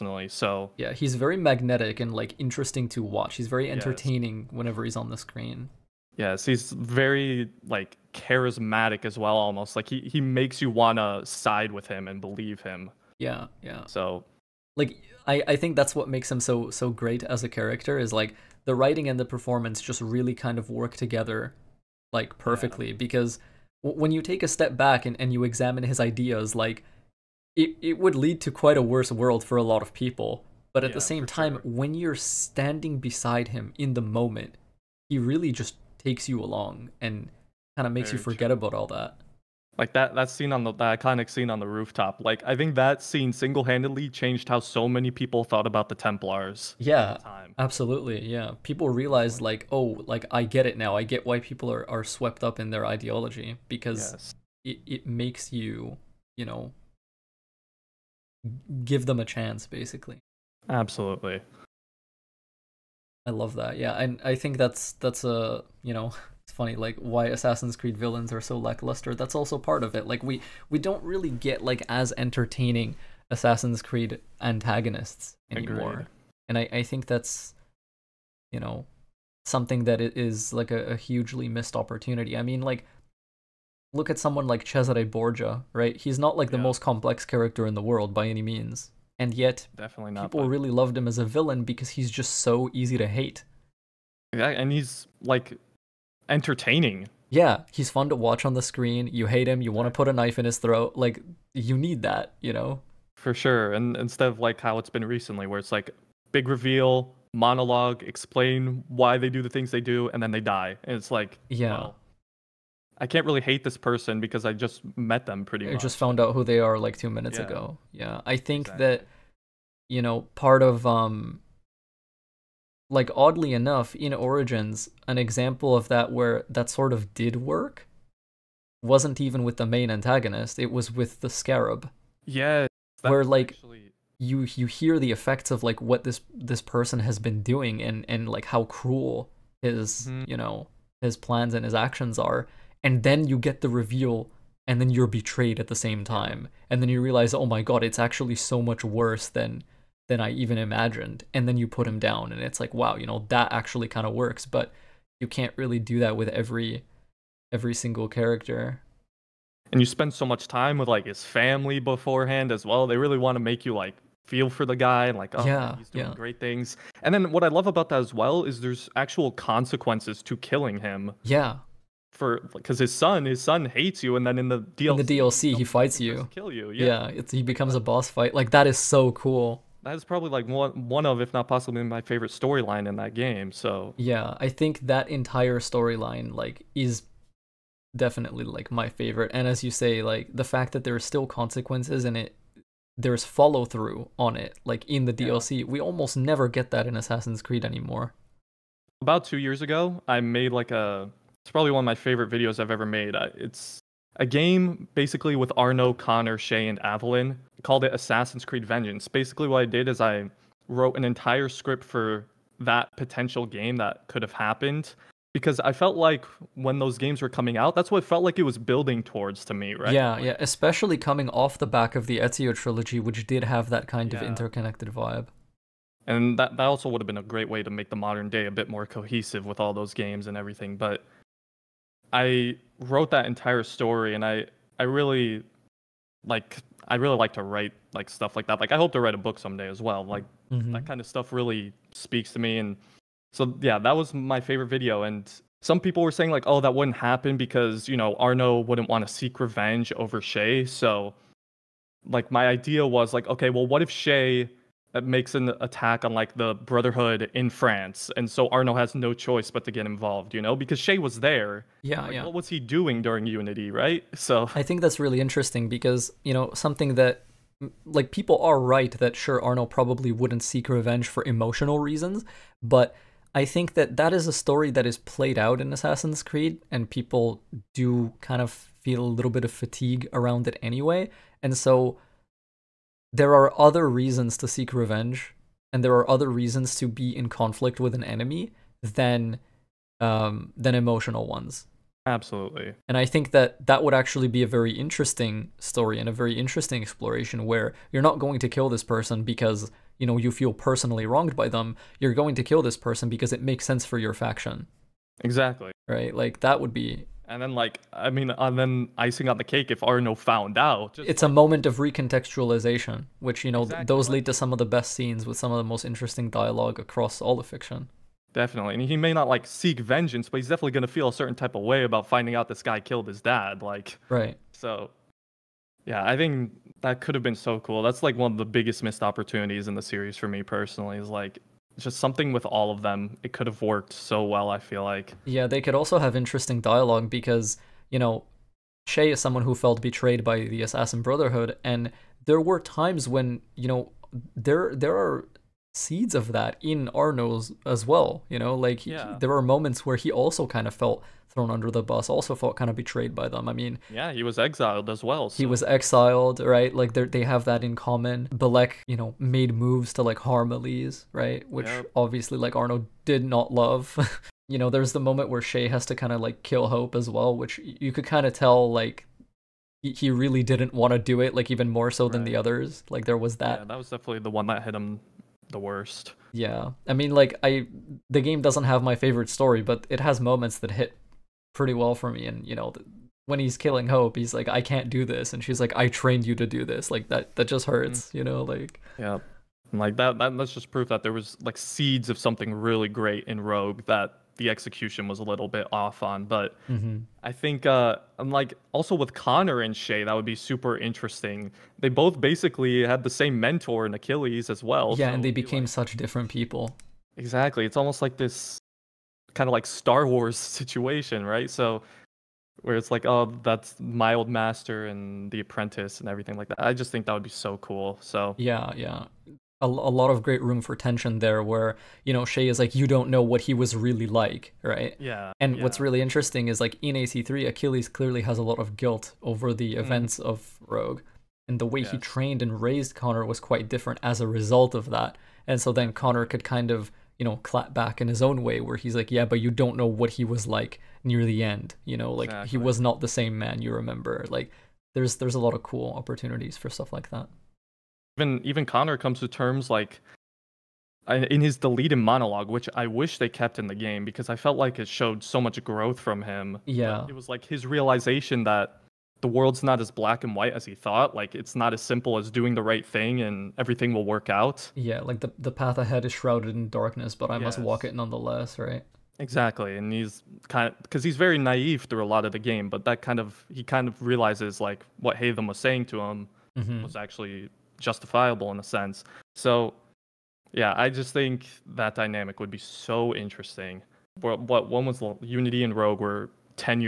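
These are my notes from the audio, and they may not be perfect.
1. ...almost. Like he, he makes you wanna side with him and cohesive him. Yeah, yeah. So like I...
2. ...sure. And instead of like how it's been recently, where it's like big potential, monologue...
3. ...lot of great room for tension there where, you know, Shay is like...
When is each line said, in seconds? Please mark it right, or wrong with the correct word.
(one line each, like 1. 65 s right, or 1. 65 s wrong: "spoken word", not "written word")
1. 9 s wrong: "believe", not "cohesive"
2. 103 s wrong: "reveal", not "potential"
3. 419 s right.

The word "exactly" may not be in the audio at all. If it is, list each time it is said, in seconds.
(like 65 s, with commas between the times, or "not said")
118 s, 305 s, 313 s, 407 s, 442 s, 469 s.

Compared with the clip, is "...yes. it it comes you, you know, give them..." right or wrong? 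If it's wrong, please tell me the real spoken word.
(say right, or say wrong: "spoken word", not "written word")
wrong: "makes", not "comes".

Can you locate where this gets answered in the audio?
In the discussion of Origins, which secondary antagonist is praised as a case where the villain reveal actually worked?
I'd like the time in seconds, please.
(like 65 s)
131 s.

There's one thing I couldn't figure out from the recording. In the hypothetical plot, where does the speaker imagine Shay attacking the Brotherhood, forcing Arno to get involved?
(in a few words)
France.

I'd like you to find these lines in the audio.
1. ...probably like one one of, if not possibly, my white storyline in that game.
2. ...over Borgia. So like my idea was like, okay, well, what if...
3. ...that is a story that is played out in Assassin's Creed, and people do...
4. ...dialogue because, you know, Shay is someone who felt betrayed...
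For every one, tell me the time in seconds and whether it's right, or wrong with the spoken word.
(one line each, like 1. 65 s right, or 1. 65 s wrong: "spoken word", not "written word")
1. 180 s wrong: "favorite", not "white"
2. 249 s wrong: "Shay", not "Borgia"
3. 273 s right
4. 336 s right.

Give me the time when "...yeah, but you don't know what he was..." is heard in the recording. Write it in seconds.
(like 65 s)
439 s.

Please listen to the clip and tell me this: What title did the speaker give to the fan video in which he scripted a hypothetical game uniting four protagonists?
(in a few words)
Assassin's Creed Vengeance.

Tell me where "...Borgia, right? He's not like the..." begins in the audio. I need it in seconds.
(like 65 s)
85 s.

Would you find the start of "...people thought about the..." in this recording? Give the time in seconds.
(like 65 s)
45 s.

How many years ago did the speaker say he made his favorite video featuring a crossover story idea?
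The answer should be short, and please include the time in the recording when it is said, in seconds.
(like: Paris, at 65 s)
2, at 199 s.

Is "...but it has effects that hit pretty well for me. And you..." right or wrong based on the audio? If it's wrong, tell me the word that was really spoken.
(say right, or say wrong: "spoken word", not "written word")
wrong: "moments", not "effects".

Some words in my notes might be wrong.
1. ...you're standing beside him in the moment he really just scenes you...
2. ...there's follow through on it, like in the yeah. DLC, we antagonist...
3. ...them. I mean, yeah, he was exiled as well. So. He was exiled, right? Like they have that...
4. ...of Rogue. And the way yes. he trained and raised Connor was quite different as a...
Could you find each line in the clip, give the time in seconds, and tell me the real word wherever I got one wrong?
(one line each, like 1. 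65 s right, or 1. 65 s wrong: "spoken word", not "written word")
1. 31 s wrong: "takes", not "scenes"
2. 192 s wrong: "almost", not "antagonist"
3. 353 s right
4. 430 s right.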